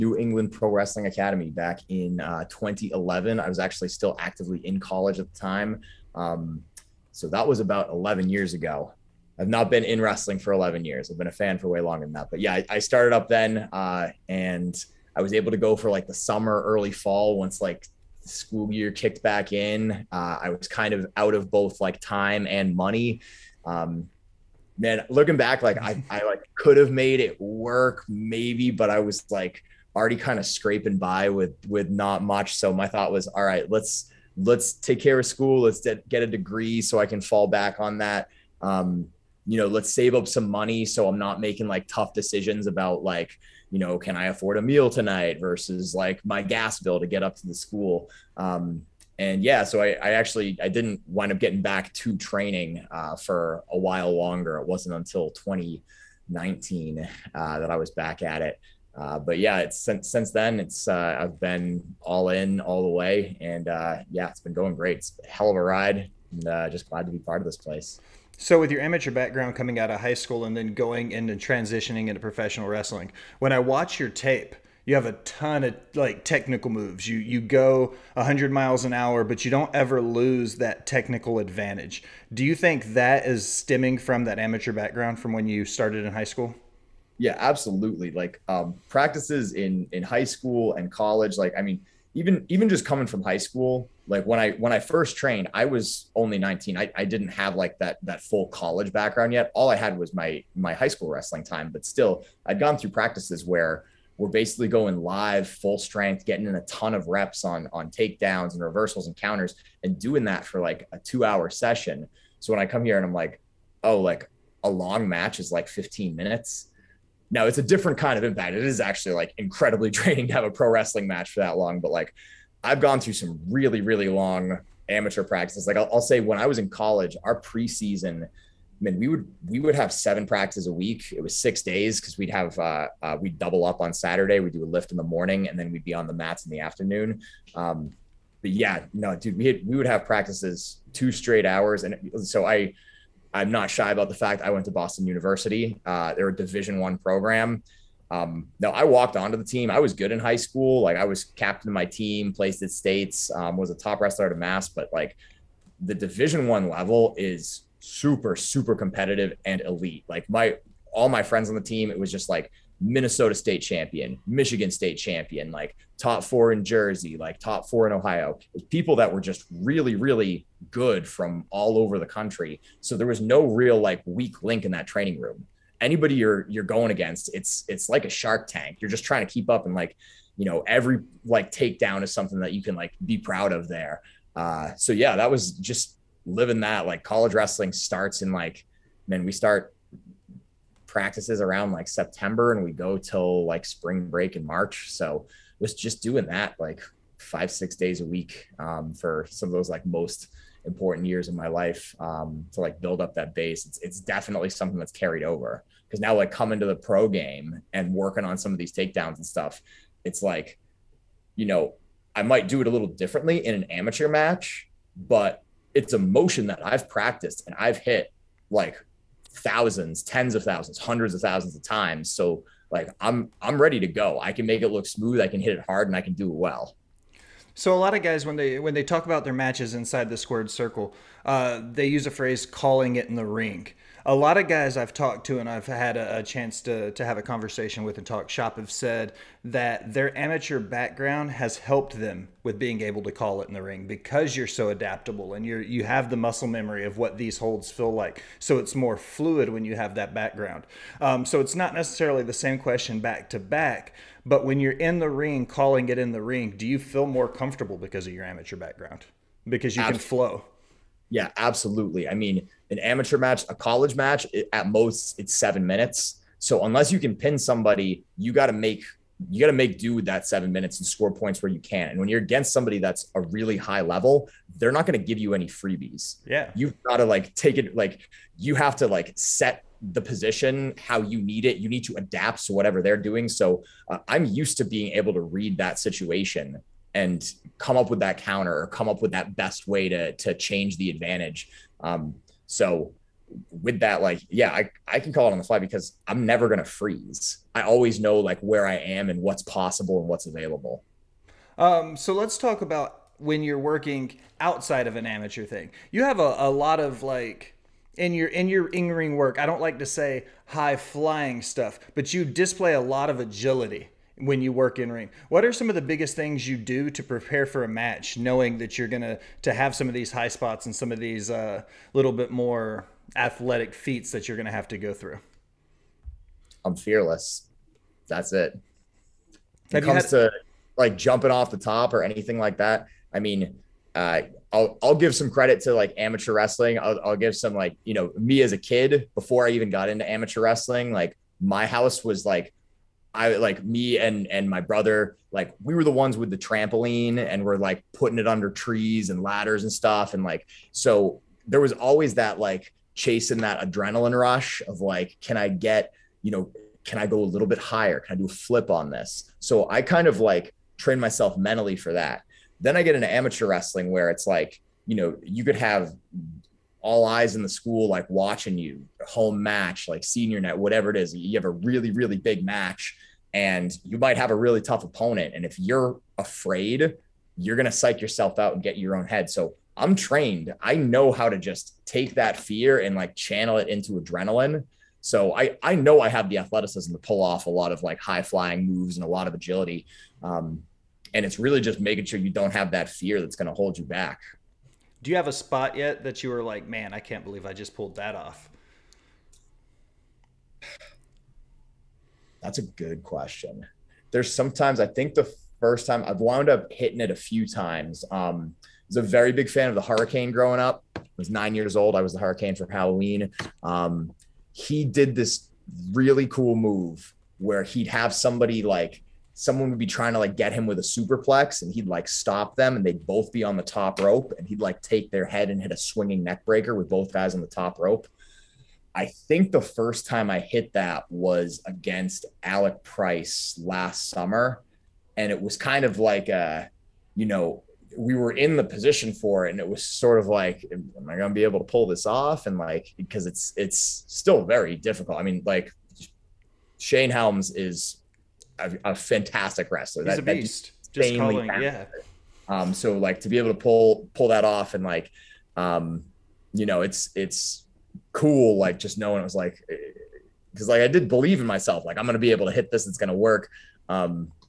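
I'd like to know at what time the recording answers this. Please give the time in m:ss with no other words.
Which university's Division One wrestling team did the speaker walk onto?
2:24.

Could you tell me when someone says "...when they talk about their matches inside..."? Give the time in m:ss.
3:48.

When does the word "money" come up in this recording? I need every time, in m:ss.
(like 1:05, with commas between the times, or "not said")
0:22, 0:40.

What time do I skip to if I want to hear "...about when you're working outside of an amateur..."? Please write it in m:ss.
5:02.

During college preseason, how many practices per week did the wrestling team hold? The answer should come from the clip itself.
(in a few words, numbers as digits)
7.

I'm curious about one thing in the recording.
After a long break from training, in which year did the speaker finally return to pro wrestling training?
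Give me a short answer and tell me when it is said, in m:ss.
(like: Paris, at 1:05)
2019, at 0:55.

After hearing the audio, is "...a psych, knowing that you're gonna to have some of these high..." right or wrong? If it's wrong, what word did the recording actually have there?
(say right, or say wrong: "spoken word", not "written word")
wrong: "match", not "psych".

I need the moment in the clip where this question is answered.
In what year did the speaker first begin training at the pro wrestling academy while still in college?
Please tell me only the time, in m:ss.
0:02.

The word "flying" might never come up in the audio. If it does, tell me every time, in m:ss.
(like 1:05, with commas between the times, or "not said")
5:10, 6:28.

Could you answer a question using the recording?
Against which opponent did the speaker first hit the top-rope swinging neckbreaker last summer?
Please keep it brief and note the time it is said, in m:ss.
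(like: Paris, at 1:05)
Alec Price, at 7:12.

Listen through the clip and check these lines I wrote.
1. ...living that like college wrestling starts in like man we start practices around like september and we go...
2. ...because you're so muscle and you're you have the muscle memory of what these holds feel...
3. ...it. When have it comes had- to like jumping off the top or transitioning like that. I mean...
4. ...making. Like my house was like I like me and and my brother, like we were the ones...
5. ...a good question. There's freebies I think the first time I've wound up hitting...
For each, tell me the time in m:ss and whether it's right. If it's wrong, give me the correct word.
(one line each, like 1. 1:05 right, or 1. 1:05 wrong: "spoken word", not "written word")
1. 3:06 right
2. 4:03 wrong: "adaptable", not "muscle"
3. 5:28 wrong: "anything", not "transitioning"
4. 5:40 wrong: "wrestling", not "making"
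5. 6:42 wrong: "sometimes", not "freebies".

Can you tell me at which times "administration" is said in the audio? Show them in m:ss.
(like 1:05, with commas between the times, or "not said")
not said.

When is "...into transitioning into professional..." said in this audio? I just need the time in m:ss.
1:11.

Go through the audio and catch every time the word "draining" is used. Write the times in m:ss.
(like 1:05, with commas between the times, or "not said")
1:59.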